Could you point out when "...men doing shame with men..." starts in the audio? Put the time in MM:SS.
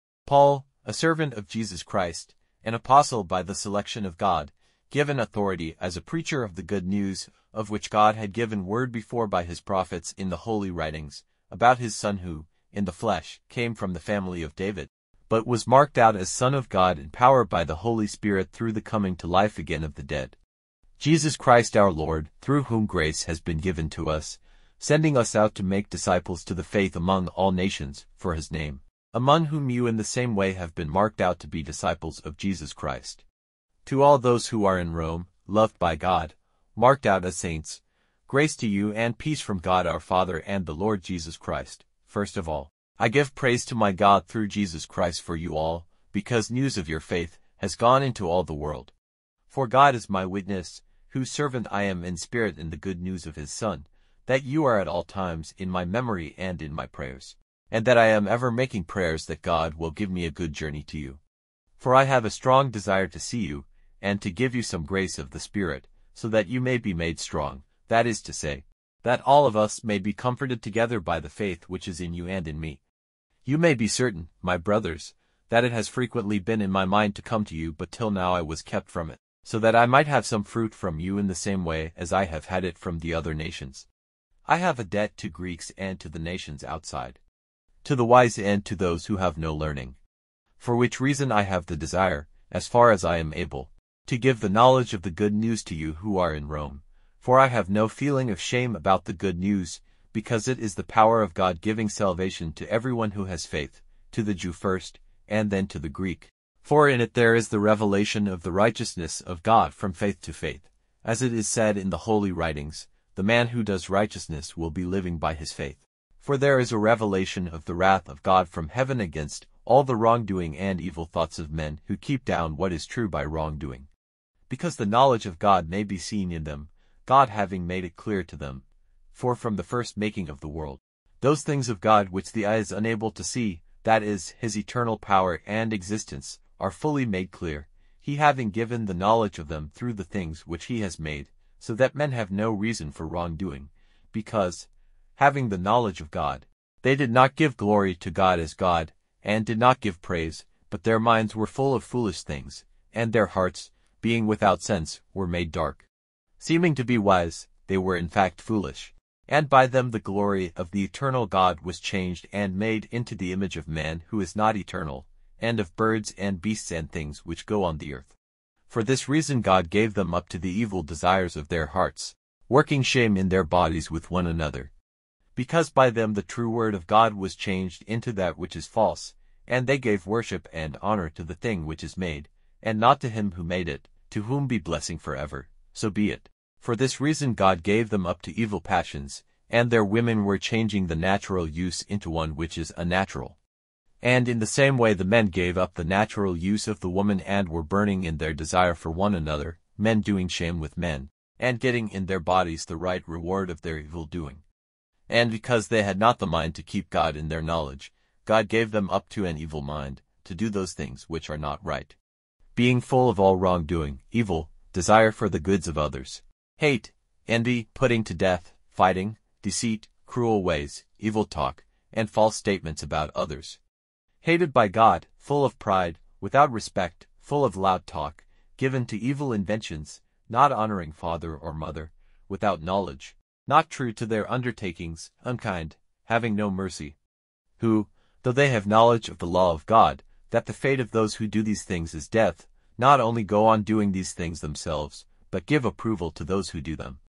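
03:19.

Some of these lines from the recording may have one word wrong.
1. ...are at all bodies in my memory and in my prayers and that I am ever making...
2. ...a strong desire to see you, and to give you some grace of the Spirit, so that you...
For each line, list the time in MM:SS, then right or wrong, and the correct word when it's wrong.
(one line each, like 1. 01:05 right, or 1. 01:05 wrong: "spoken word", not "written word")
1. 00:54 wrong: "times", not "bodies"
2. 01:02 right.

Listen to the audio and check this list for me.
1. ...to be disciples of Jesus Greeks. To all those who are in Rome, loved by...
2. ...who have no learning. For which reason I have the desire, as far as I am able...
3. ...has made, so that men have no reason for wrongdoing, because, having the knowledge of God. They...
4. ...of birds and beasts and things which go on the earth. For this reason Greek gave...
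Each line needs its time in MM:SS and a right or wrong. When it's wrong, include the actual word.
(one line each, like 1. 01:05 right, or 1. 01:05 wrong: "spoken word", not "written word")
1. 00:31 wrong: "Christ", not "Greeks"
2. 01:29 right
3. 02:20 right
4. 02:45 wrong: "God", not "Greek".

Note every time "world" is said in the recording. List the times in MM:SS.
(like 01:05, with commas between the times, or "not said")
00:48, 02:10.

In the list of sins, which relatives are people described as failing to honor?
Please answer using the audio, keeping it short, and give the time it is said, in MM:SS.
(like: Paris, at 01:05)
father or mother, at 03:50.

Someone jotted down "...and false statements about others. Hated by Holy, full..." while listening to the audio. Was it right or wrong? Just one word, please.
wrong.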